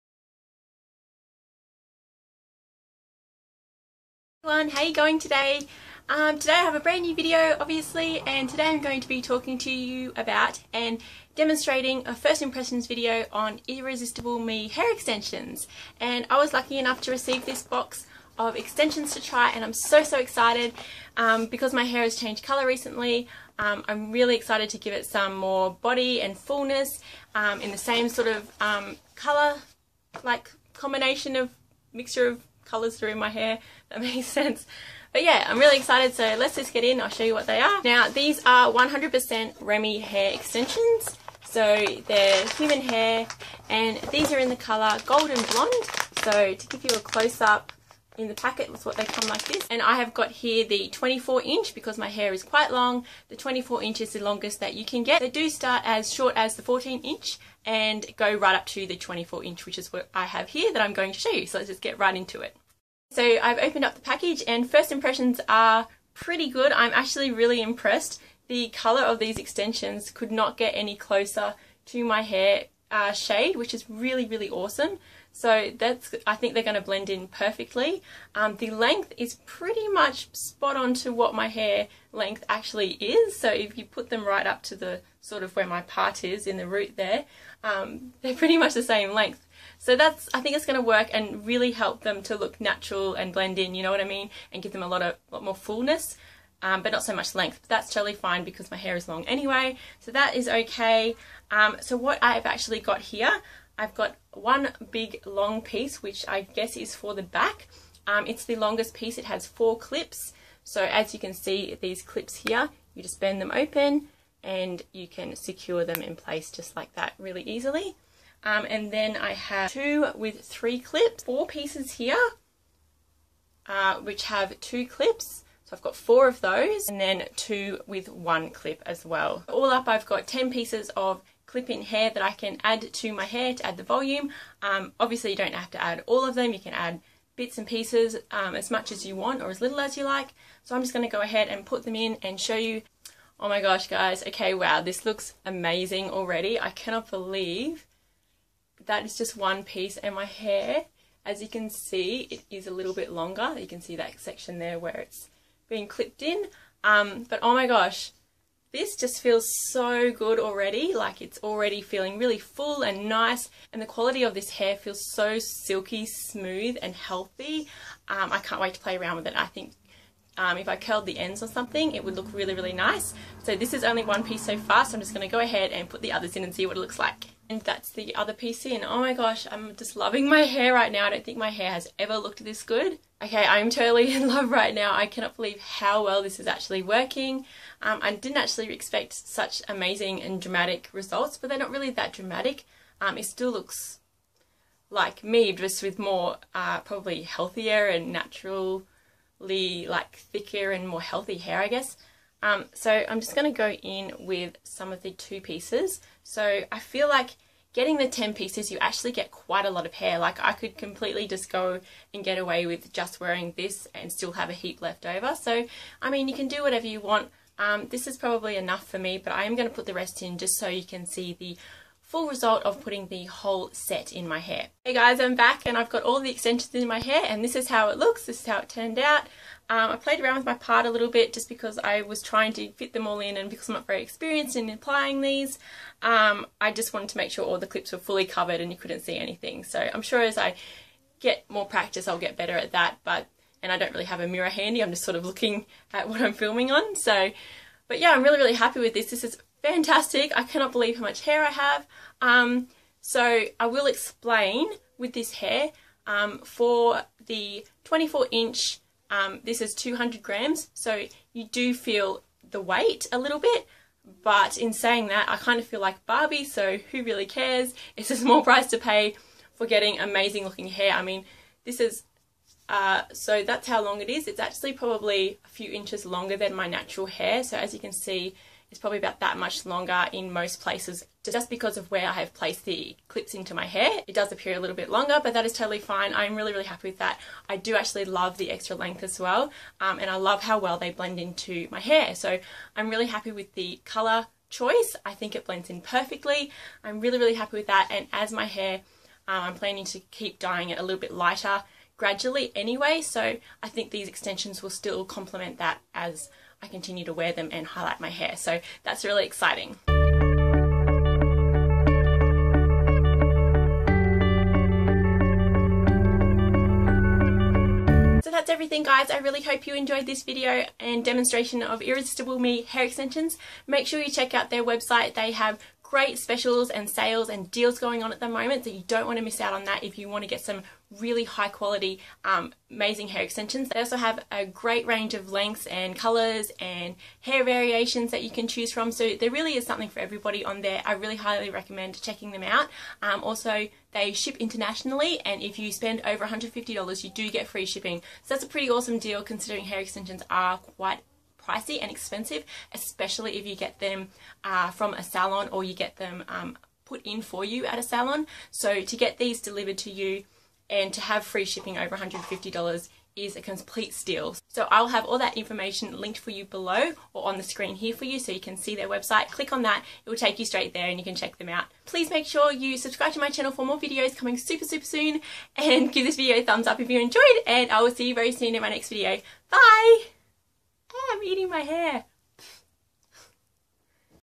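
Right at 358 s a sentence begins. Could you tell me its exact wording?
So to get these delivered to you and to have free shipping over $150 is a complete steal.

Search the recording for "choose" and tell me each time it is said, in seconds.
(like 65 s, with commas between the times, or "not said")
338 s.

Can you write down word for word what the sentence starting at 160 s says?
Like it's already feeling really full and nice.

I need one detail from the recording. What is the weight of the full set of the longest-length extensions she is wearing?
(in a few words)
200 grams.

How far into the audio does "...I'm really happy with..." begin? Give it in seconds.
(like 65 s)
292 s.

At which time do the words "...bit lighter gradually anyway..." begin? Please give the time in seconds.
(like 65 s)
300 s.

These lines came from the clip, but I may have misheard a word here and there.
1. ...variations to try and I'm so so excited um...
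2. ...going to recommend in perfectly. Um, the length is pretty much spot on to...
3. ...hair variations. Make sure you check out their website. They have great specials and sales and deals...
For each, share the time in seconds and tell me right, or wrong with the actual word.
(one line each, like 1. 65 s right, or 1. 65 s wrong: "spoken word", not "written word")
1. 18 s wrong: "extensions", not "variations"
2. 76 s wrong: "blend", not "recommend"
3. 322 s wrong: "extensions", not "variations".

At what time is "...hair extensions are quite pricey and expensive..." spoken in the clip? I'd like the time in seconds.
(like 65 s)
349 s.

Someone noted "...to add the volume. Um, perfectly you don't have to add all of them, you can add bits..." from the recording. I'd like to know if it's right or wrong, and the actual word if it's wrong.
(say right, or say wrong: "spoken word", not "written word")
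wrong: "obviously", not "perfectly".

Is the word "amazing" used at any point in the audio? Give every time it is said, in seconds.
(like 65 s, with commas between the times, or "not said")
145 s, 189 s, 269 s, 332 s.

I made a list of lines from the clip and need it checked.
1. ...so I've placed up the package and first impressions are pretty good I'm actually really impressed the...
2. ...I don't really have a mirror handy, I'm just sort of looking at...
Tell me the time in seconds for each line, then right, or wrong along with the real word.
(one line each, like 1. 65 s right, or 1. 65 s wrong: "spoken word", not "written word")
1. 63 s wrong: "opened", not "placed"
2. 243 s right.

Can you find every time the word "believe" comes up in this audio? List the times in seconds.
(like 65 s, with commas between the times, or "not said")
147 s, 185 s, 250 s.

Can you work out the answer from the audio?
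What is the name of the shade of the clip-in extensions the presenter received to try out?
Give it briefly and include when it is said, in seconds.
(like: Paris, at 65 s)
Golden Blonde, at 45 s.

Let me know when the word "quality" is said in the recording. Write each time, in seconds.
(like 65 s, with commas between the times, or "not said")
163 s, 331 s.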